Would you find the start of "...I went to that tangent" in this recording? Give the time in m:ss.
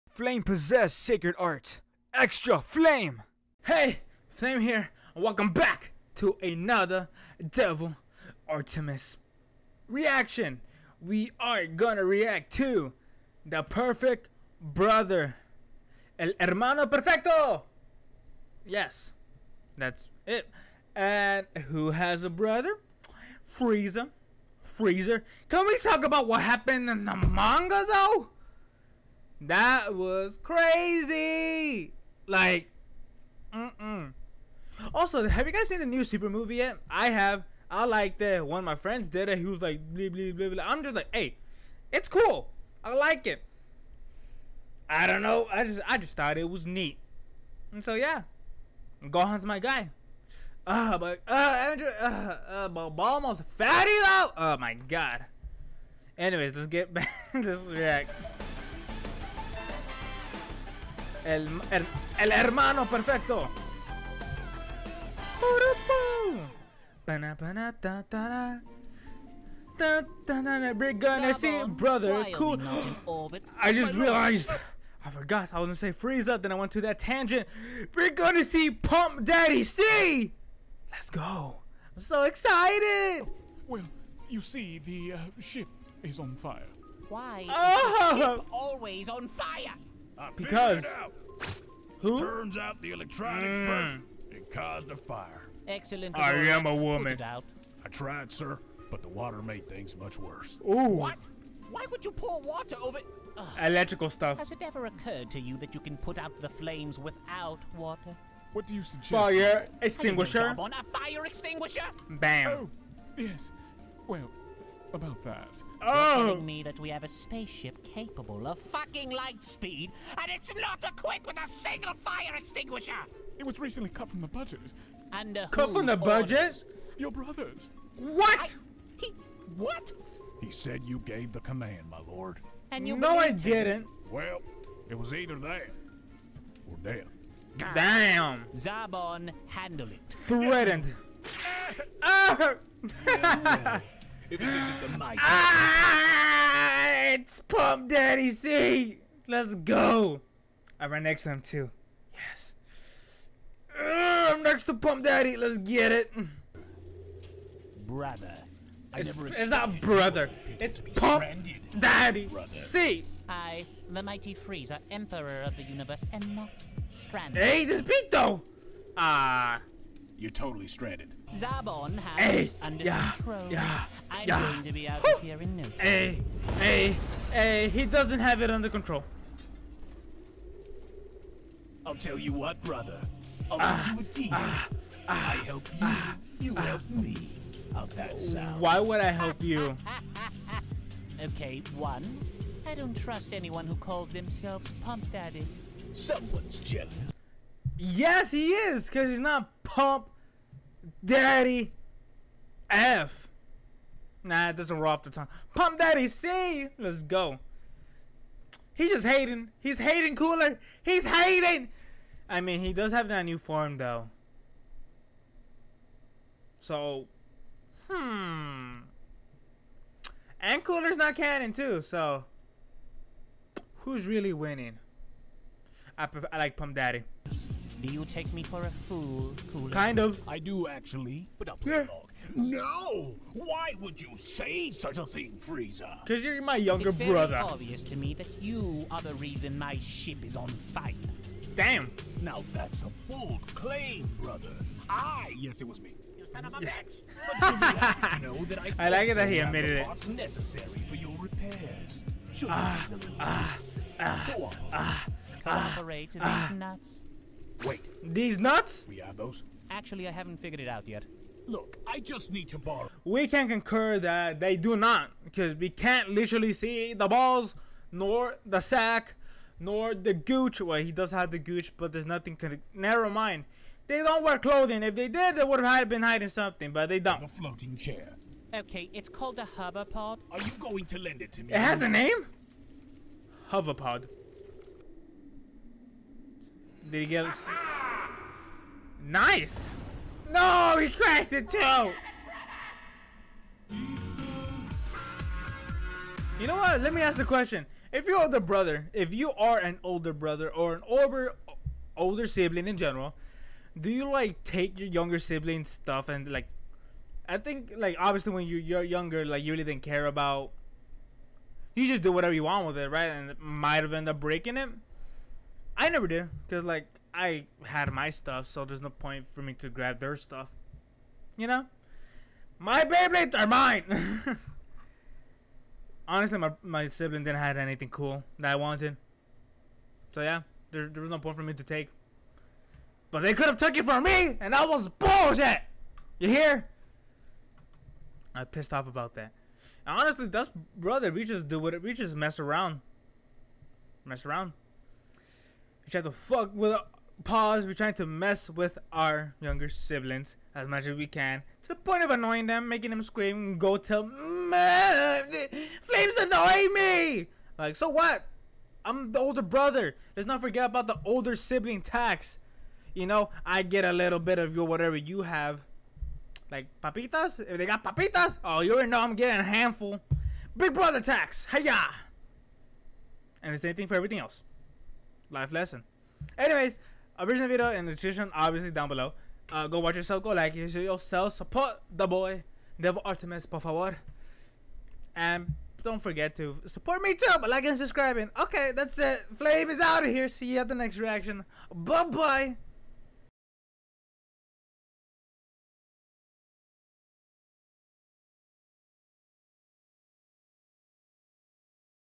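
1:16.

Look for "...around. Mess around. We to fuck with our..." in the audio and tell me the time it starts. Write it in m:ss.
5:42.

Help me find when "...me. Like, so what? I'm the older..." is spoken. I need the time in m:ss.
5:56.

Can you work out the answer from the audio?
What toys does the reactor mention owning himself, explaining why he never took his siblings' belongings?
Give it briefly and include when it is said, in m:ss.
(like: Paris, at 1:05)
Beyblades, at 5:22.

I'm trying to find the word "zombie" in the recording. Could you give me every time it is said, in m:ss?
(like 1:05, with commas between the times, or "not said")
not said.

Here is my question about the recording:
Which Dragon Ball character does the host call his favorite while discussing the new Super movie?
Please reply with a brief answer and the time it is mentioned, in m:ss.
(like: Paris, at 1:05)
Gohan, at 0:49.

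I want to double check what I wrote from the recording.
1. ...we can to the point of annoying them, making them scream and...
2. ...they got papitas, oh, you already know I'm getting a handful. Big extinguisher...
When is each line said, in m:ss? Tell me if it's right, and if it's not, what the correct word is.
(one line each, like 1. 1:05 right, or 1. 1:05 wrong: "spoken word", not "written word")
1. 5:50 right
2. 6:07 wrong: "brother", not "extinguisher".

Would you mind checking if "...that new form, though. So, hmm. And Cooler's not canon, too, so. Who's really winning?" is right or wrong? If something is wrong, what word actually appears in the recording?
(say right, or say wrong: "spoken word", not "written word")
right.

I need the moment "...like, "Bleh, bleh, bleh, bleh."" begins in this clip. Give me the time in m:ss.
0:39.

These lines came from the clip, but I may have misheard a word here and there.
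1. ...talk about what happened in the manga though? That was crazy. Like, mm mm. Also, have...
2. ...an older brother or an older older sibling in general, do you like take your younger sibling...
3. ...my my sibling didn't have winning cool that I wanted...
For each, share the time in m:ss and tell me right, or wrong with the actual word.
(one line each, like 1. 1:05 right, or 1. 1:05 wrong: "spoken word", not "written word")
1. 0:25 right
2. 4:59 right
3. 5:26 wrong: "anything", not "winning".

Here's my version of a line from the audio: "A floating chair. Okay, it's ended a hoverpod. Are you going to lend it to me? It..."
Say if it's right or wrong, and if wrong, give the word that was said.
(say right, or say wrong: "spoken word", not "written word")
wrong: "called", not "ended".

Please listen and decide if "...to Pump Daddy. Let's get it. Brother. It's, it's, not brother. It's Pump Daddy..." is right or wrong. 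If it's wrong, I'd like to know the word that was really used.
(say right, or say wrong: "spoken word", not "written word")
right.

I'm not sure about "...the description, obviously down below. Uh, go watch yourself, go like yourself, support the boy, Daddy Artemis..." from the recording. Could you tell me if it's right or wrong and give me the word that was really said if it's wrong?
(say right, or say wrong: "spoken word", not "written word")
wrong: "Devil", not "Daddy".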